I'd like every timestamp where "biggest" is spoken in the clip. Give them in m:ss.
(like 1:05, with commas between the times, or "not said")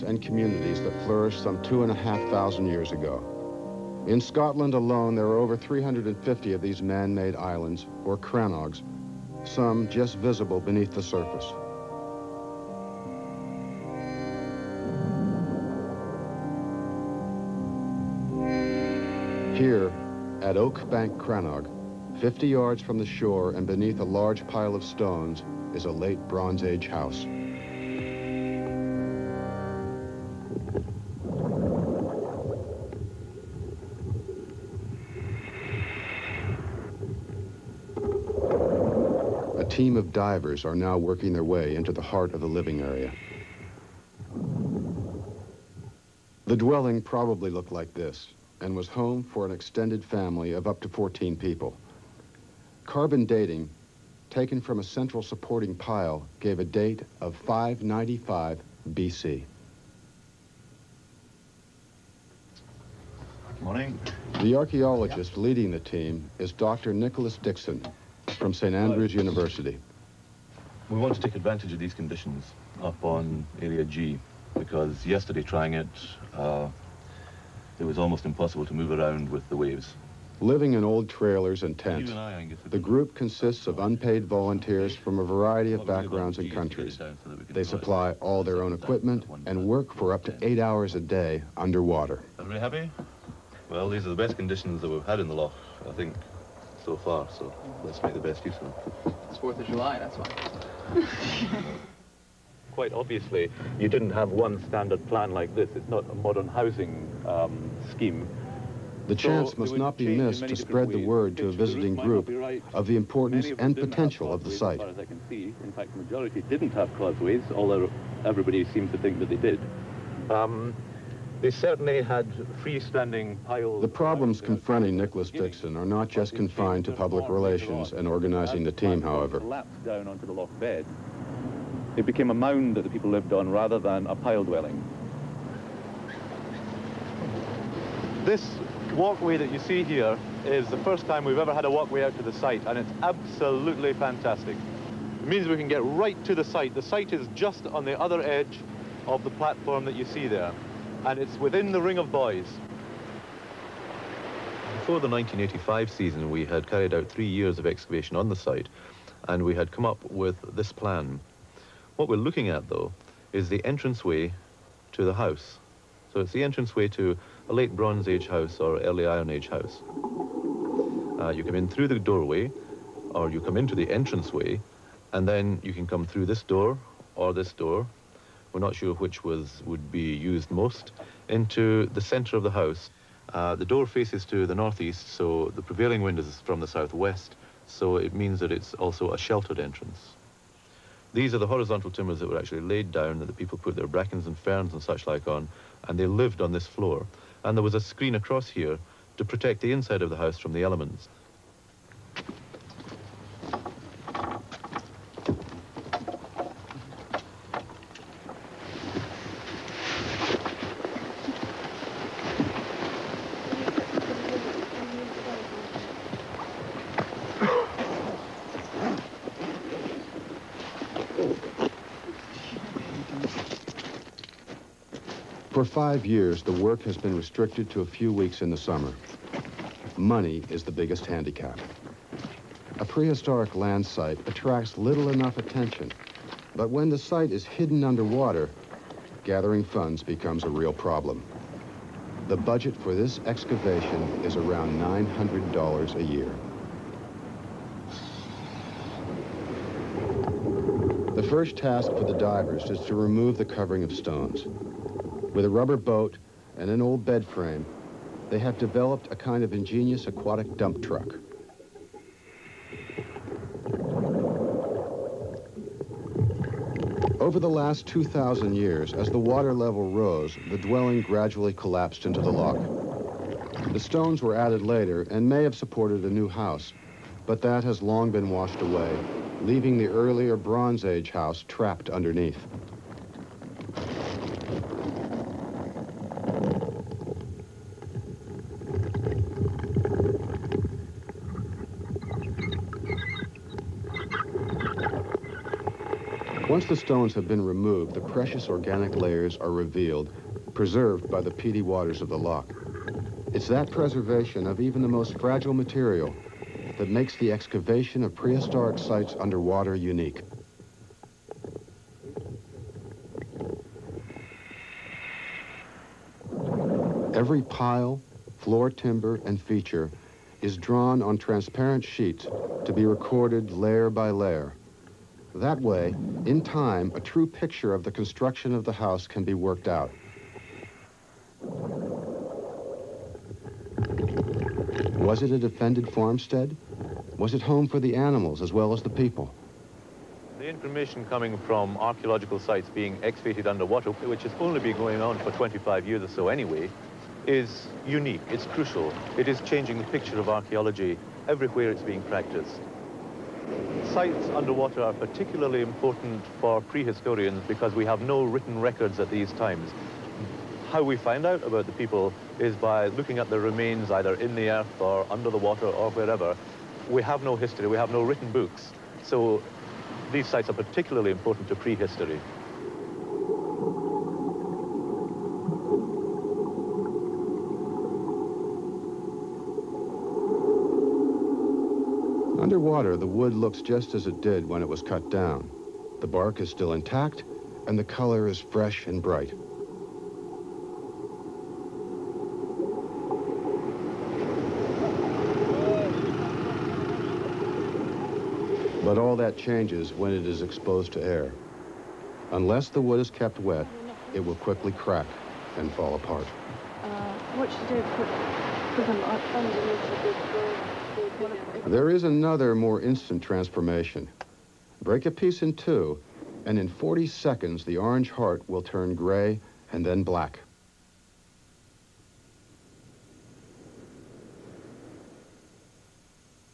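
3:50.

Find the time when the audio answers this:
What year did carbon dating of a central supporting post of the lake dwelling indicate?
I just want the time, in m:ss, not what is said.
0:57.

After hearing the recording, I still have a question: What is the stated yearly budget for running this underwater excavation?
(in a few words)
$900.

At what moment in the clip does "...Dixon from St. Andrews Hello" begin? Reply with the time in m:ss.
1:07.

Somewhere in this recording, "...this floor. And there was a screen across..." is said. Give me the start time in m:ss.
3:16.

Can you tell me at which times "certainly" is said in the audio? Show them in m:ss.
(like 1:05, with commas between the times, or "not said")
2:01.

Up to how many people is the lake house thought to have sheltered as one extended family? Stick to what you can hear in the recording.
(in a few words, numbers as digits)
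14.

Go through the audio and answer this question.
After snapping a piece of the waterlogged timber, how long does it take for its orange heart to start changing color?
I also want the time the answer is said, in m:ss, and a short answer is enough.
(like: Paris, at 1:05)
40 seconds, at 6:56.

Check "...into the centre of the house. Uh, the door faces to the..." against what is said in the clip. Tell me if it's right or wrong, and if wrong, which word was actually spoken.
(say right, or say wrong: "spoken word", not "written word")
right.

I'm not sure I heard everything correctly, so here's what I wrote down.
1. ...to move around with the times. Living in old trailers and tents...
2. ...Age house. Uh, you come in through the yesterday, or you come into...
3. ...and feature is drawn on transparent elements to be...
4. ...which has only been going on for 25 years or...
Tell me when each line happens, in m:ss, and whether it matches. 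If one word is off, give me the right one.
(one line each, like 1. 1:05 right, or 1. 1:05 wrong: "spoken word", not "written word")
1. 1:18 wrong: "waves", not "times"
2. 2:49 wrong: "doorway", not "yesterday"
3. 5:19 wrong: "sheets", not "elements"
4. 5:43 right.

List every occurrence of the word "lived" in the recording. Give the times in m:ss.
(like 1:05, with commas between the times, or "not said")
2:13, 3:16.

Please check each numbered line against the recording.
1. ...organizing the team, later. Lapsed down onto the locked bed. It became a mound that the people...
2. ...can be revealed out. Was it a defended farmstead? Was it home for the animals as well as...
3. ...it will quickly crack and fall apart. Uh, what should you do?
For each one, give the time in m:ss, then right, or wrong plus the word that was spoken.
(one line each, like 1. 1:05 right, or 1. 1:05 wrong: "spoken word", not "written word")
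1. 2:08 wrong: "however", not "later"
2. 5:29 wrong: "worked", not "revealed"
3. 6:44 right.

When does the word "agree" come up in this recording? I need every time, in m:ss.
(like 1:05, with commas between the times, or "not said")
not said.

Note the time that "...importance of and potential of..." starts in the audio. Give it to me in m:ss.
1:52.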